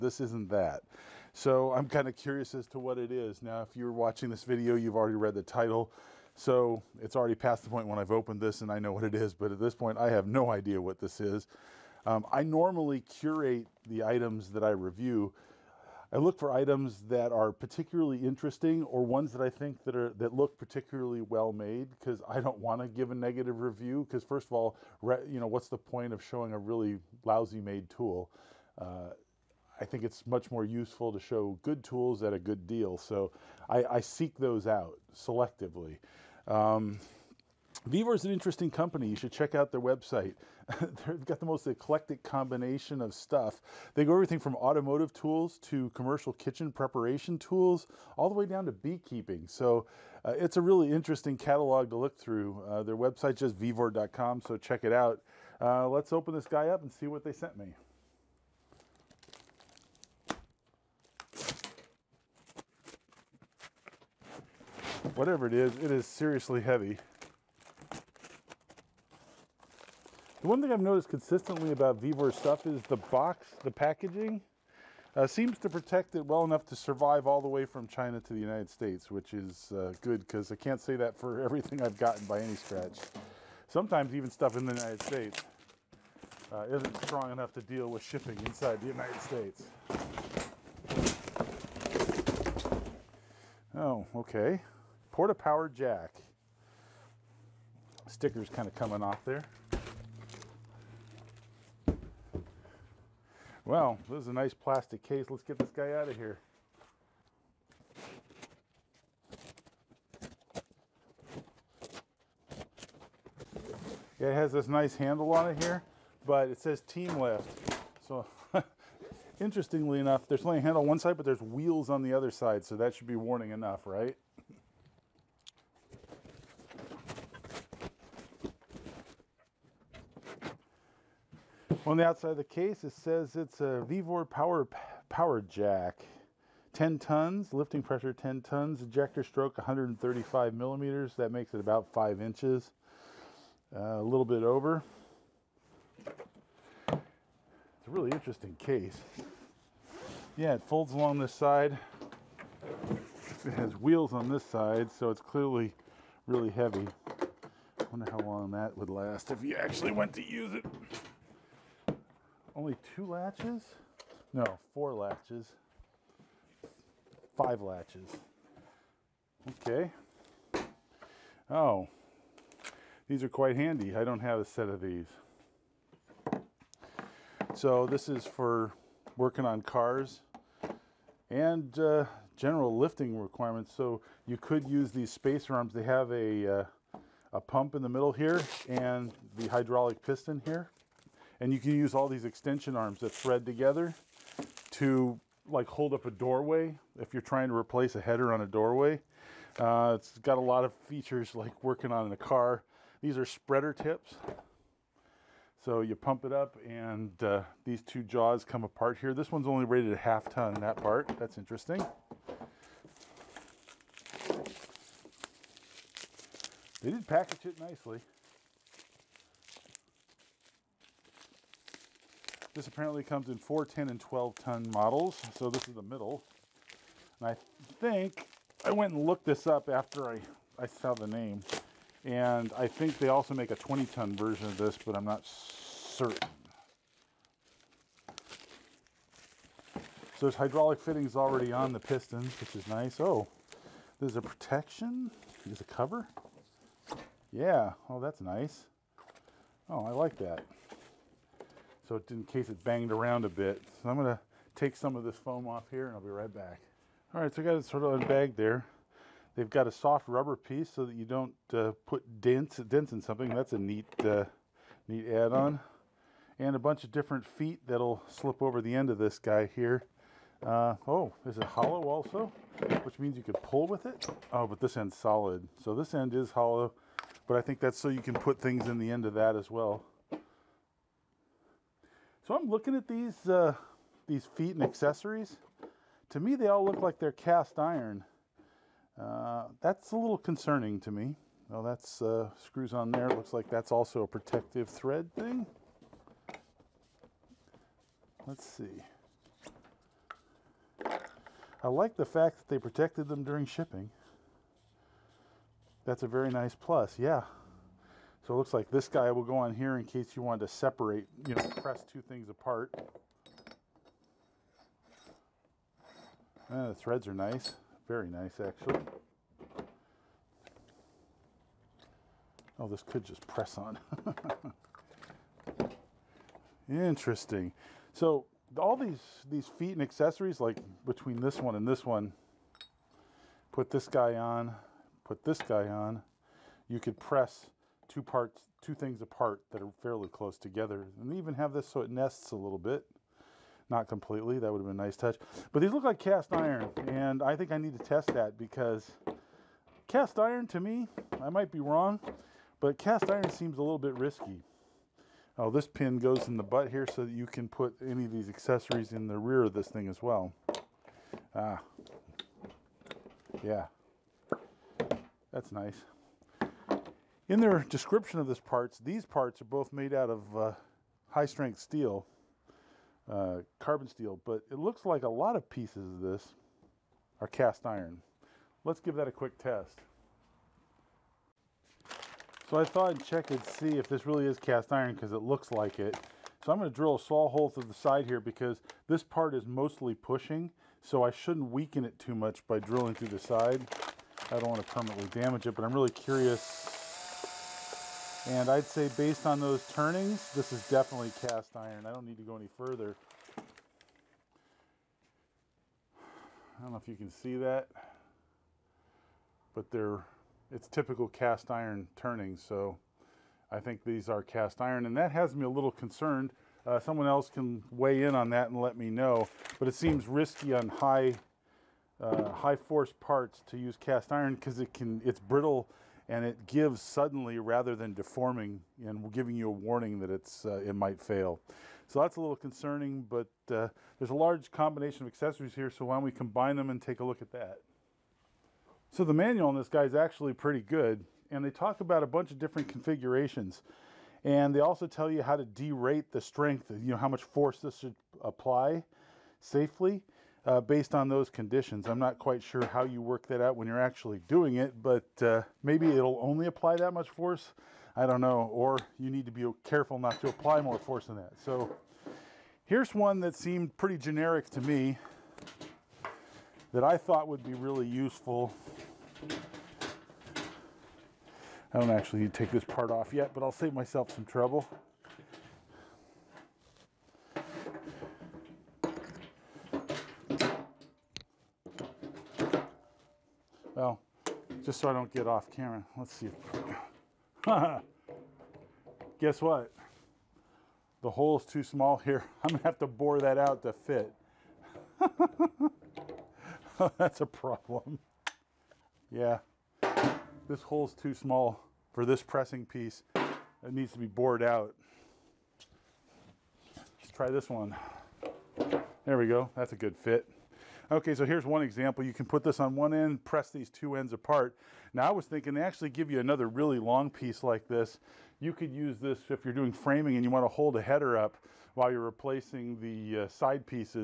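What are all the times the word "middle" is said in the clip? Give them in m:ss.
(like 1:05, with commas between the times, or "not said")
3:07, 3:45.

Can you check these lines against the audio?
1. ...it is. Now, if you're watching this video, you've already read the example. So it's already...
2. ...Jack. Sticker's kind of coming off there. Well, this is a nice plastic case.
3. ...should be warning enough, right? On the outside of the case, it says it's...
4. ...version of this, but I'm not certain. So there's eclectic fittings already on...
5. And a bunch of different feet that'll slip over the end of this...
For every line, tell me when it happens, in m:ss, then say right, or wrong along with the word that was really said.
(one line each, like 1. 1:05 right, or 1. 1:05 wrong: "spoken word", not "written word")
1. 0:02 wrong: "title", not "example"
2. 1:35 right
3. 2:02 right
4. 3:54 wrong: "hydraulic", not "eclectic"
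5. 4:26 right.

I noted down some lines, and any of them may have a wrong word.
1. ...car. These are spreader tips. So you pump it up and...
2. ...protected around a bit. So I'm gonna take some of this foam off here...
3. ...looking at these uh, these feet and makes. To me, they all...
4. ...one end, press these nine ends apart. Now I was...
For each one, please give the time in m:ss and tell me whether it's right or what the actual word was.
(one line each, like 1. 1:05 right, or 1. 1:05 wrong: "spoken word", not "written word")
1. 3:22 right
2. 4:12 wrong: "banged", not "protected"
3. 4:42 wrong: "accessories", not "makes"
4. 8:32 wrong: "two", not "nine".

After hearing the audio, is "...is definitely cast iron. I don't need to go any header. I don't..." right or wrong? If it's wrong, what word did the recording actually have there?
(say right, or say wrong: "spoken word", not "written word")
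wrong: "further", not "header".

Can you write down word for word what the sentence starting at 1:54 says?
it has this nice handle on it here, but it says team lift.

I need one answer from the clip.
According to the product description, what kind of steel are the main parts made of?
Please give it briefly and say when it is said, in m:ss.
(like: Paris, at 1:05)
Carbon steel, at 6:13.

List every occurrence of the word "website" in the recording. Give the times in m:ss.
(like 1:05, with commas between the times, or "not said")
0:39, 0:52.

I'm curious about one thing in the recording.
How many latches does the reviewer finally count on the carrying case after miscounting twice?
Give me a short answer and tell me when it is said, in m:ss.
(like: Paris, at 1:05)
5, at 2:47.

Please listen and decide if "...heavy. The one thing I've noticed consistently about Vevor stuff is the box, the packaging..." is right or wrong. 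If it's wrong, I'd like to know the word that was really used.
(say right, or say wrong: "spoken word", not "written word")
right.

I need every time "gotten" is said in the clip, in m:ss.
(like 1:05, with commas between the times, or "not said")
1:21.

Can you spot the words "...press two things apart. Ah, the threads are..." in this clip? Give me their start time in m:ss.
5:11.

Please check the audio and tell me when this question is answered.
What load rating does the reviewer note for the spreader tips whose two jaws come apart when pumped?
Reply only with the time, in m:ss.
3:29.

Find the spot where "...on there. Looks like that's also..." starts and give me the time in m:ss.
4:52.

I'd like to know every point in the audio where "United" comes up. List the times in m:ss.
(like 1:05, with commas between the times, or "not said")
1:18, 1:24, 1:28.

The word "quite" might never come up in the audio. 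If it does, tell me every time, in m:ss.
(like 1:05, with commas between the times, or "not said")
2:53, 7:32.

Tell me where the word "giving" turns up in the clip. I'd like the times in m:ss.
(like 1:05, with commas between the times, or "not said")
7:09.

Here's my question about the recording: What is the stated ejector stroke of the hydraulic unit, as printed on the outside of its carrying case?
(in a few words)
135 millimeters.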